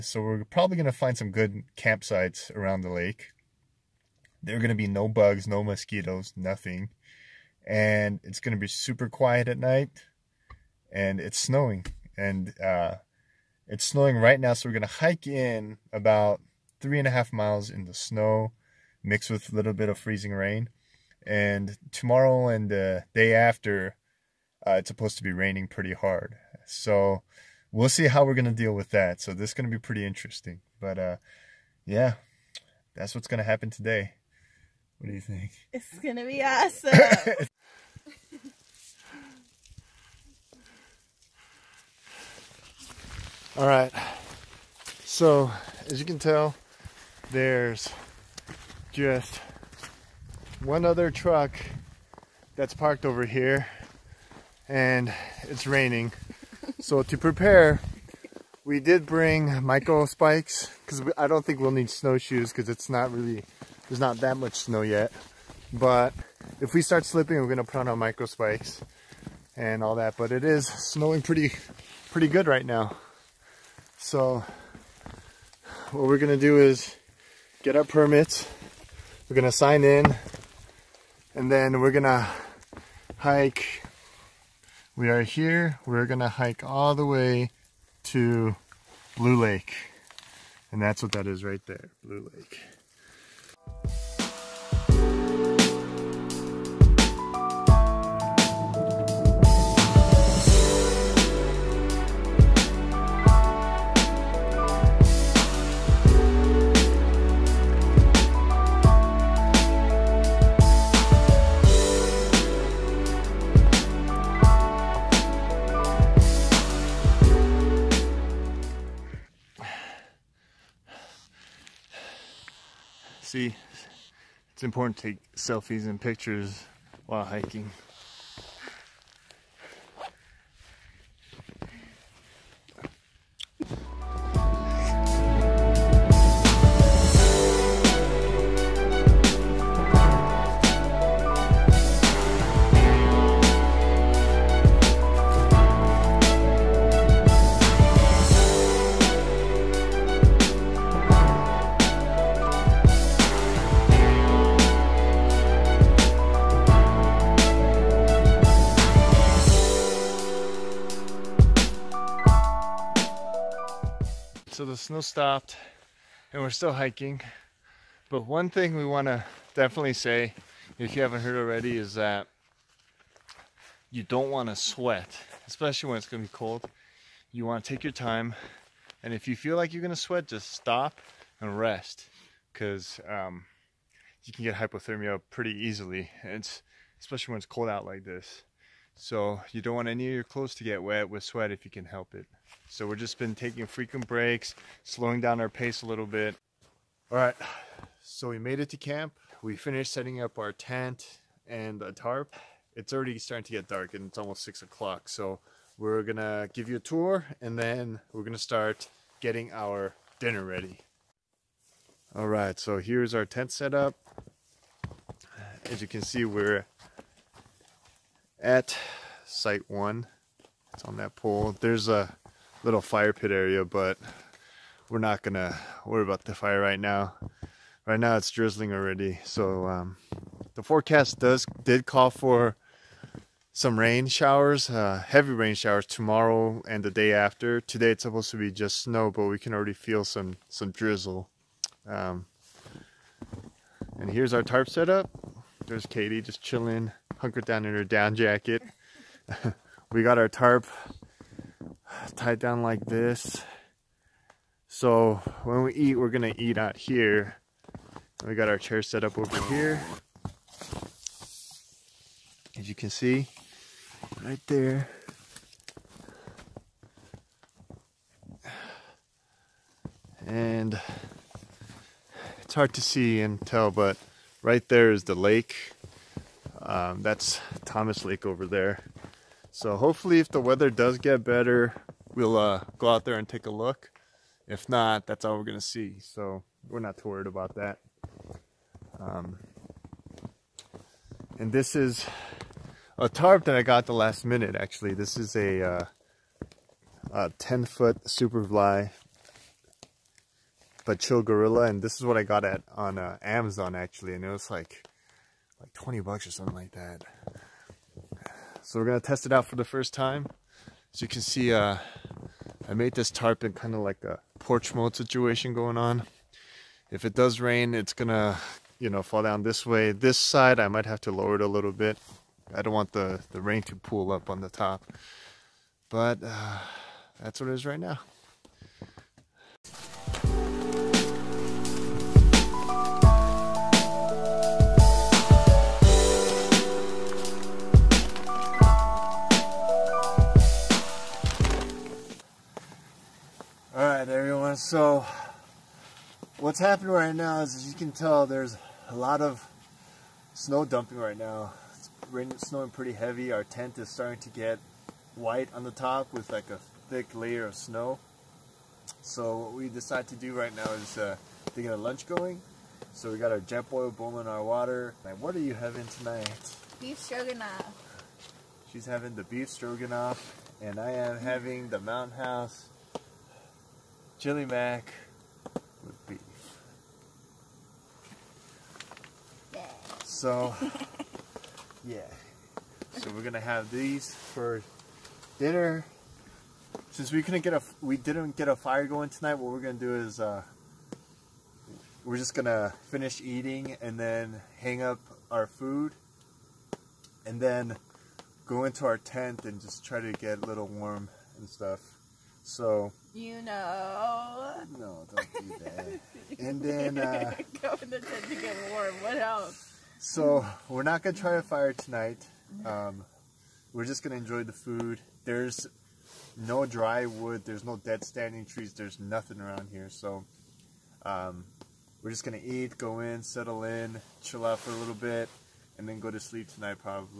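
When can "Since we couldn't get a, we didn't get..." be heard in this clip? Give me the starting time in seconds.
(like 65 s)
386 s.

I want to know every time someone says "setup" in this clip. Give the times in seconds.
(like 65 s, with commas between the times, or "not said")
213 s, 244 s.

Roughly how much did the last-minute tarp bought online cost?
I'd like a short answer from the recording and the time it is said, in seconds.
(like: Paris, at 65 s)
$20, at 305 s.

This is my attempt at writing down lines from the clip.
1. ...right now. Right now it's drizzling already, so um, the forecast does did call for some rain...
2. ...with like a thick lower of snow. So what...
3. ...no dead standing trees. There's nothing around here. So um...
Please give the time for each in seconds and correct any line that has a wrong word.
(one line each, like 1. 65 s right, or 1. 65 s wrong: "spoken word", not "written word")
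1. 226 s right
2. 356 s wrong: "layer", not "lower"
3. 417 s right.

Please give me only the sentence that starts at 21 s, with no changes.
And tomorrow and the day after, uh, it's supposed to be raining pretty hard.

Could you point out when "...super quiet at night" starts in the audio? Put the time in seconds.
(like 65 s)
8 s.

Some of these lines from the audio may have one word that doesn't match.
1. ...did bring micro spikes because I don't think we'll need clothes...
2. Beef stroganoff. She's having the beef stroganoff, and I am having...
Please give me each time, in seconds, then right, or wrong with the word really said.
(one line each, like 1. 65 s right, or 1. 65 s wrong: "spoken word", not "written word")
1. 58 s wrong: "snowshoes", not "clothes"
2. 366 s right.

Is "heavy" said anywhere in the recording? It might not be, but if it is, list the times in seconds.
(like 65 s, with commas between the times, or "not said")
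235 s, 352 s.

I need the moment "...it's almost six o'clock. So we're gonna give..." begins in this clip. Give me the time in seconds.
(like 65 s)
204 s.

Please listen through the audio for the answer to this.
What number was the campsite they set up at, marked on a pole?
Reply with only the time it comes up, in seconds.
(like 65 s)
219 s.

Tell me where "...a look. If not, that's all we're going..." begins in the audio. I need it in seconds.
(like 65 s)
283 s.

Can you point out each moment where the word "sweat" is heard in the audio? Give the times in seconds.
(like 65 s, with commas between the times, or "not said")
174 s, 179 s, 191 s.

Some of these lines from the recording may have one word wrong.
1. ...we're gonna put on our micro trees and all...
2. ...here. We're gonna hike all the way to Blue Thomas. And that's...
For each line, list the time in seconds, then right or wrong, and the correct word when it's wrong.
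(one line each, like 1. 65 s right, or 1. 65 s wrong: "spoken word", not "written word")
1. 67 s wrong: "spikes", not "trees"
2. 85 s wrong: "Lake", not "Thomas".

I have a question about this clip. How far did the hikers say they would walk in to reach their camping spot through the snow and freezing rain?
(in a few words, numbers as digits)
3.5 miles.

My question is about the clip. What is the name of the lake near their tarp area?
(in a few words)
Thomas Lake.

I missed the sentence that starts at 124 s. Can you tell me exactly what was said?
it's important to take selfies and pictures while hiking.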